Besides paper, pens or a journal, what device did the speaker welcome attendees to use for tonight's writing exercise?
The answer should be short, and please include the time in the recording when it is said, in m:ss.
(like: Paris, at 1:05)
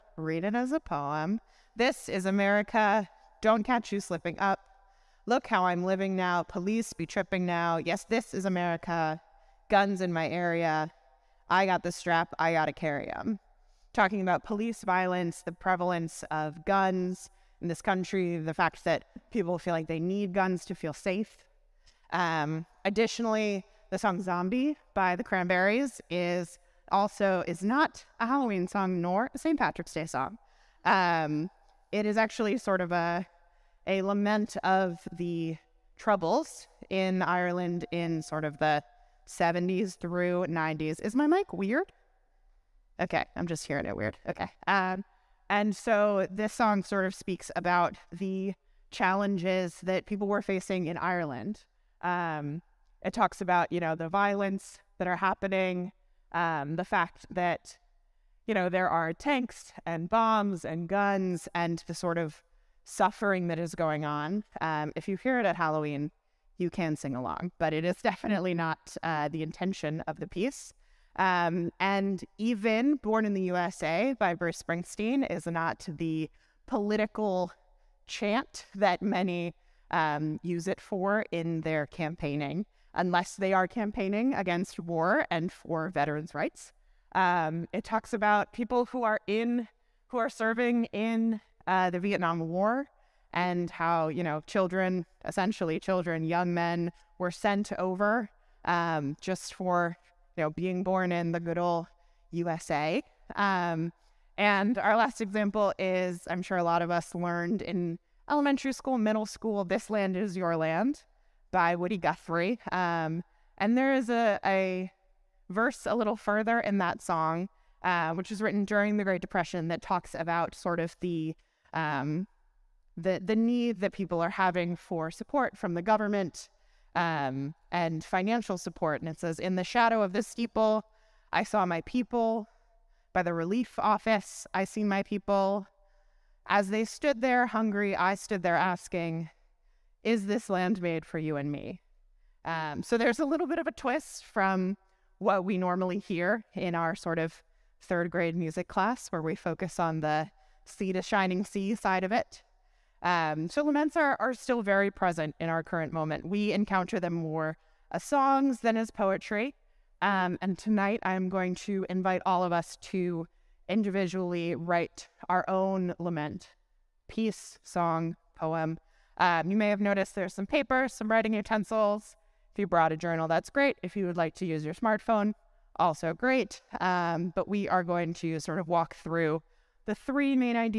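smartphone, at 2:54.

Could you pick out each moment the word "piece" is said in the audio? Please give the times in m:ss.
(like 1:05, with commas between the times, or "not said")
1:10, 2:47.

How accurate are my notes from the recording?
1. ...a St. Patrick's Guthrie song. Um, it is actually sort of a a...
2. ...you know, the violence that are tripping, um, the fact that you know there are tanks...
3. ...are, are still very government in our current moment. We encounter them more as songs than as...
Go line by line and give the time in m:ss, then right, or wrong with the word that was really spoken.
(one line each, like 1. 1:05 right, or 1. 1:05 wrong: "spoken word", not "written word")
1. 0:29 wrong: "Day", not "Guthrie"
2. 0:53 wrong: "happening", not "tripping"
3. 2:33 wrong: "present", not "government".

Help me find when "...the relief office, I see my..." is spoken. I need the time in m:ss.
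2:13.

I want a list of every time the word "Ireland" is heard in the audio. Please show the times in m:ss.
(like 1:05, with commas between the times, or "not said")
0:37, 0:50.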